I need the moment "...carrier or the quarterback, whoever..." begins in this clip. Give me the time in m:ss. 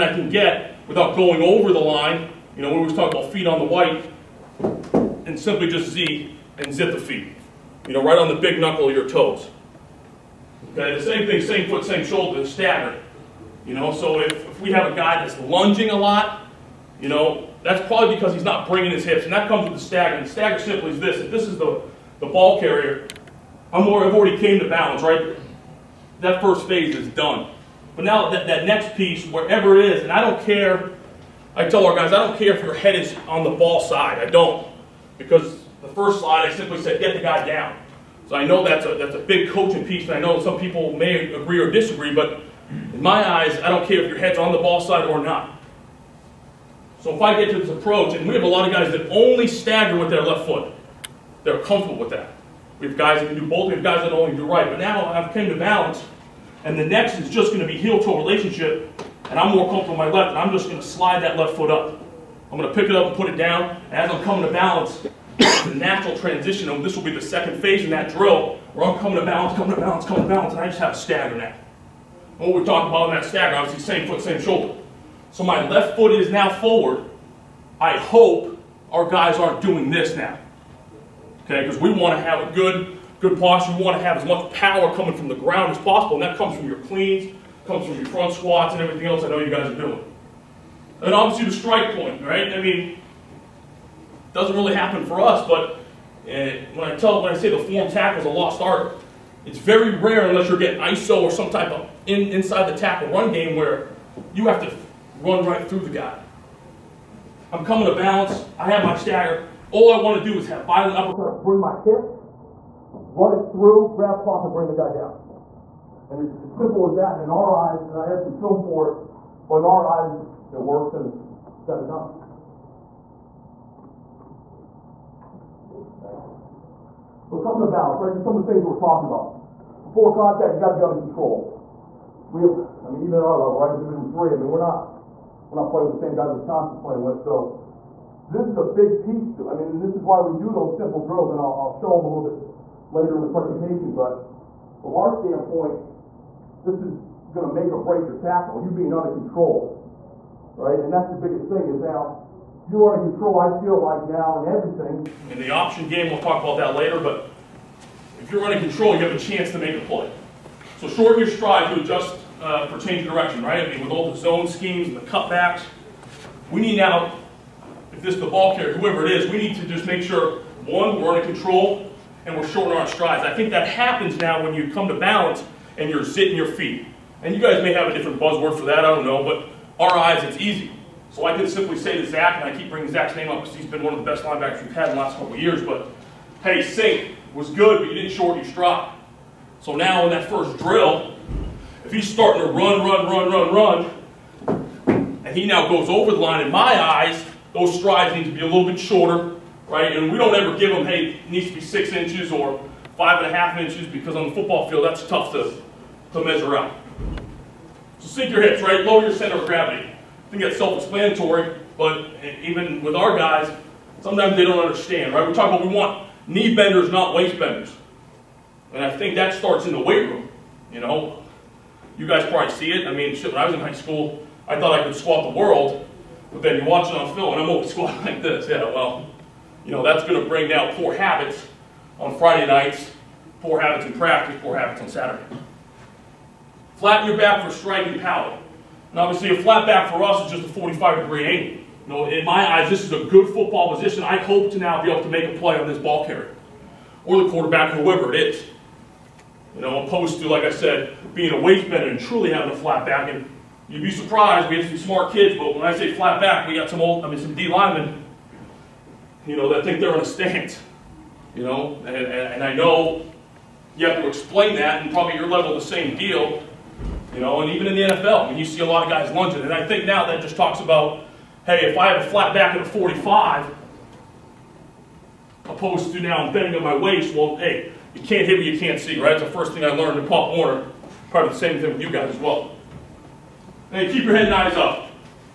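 4:06.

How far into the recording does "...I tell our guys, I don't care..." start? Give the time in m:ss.
0:31.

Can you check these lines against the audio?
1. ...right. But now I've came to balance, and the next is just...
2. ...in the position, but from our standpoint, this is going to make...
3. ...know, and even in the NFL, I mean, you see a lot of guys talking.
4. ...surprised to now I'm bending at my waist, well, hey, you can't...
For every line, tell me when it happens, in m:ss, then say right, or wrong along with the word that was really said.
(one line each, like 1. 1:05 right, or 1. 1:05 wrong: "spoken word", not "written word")
1. 0:54 right
2. 2:23 wrong: "presentation", not "position"
3. 4:27 wrong: "lunging", not "talking"
4. 4:35 wrong: "opposed", not "surprised".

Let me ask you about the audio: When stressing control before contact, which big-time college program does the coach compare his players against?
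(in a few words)
Wisconsin.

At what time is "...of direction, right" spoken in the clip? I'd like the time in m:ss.
2:43.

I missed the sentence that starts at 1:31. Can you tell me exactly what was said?
And obviously the strike point, right?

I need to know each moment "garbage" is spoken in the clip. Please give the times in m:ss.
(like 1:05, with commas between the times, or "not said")
not said.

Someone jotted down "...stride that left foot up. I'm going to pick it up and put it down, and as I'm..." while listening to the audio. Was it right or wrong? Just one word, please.
wrong.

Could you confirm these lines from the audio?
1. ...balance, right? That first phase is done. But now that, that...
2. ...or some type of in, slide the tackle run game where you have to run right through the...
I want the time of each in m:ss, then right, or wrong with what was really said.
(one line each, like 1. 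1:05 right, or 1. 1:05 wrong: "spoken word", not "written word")
1. 0:24 right
2. 1:41 wrong: "inside", not "slide".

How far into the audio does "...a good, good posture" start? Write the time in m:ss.
1:22.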